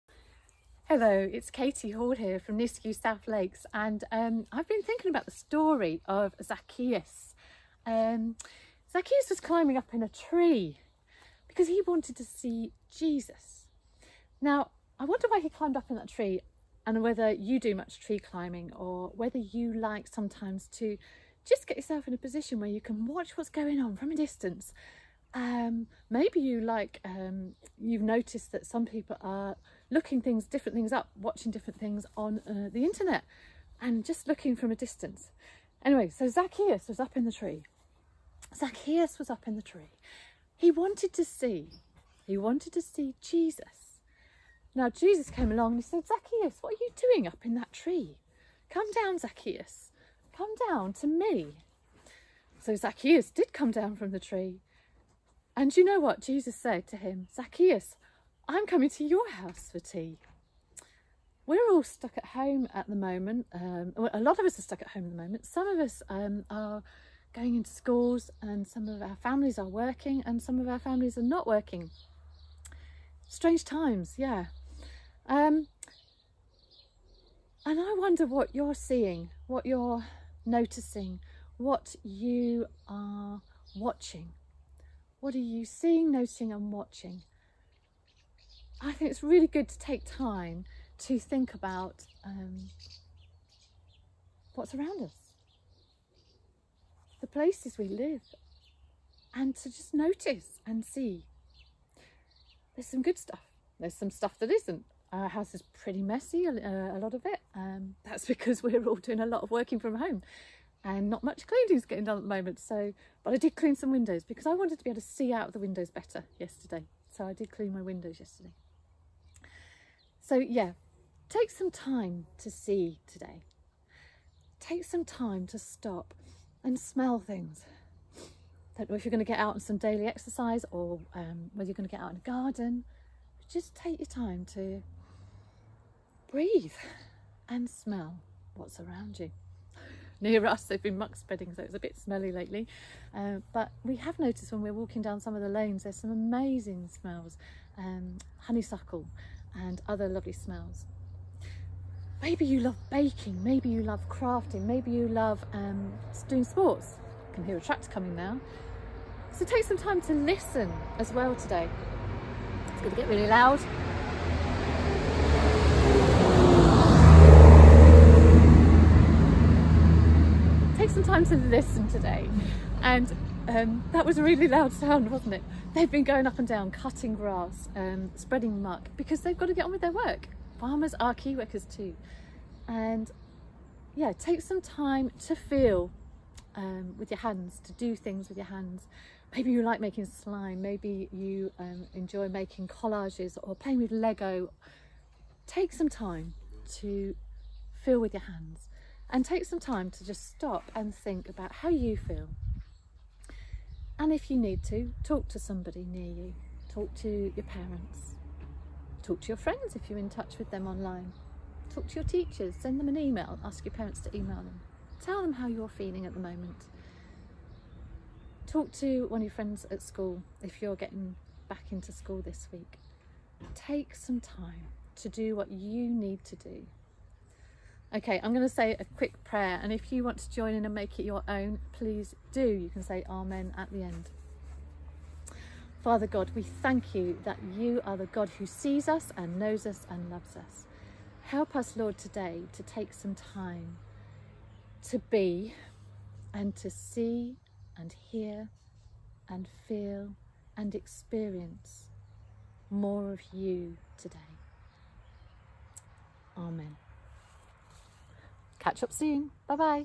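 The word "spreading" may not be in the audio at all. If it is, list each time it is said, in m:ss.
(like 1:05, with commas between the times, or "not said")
2:21, 2:58.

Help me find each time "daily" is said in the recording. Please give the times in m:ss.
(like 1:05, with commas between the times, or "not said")
2:09.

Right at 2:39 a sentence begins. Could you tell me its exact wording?
So take some time to listen as well today.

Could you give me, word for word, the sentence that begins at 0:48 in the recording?
Come down, Zacchaeus, come down to me.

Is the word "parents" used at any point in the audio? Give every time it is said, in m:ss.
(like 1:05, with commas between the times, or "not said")
3:27, 3:33.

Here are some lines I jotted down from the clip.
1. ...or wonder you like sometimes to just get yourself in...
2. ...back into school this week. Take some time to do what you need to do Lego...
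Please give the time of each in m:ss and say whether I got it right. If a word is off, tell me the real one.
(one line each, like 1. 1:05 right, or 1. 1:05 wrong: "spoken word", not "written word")
1. 0:18 wrong: "whether", not "wonder"
2. 3:41 wrong: "Okay", not "Lego".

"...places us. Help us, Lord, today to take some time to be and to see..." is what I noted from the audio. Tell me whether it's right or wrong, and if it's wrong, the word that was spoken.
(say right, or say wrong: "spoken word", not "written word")
wrong: "loves", not "places".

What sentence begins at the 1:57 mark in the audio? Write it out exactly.
So I did clean my windows yesterday.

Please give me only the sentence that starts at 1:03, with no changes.
Um, well, a lot of us are stuck at home at the moment.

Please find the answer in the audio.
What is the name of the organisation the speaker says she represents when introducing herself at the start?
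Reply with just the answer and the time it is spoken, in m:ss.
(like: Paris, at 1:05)
NISCU South Lakes, at 0:02.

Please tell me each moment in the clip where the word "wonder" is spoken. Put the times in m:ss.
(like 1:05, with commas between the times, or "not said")
0:15, 1:17.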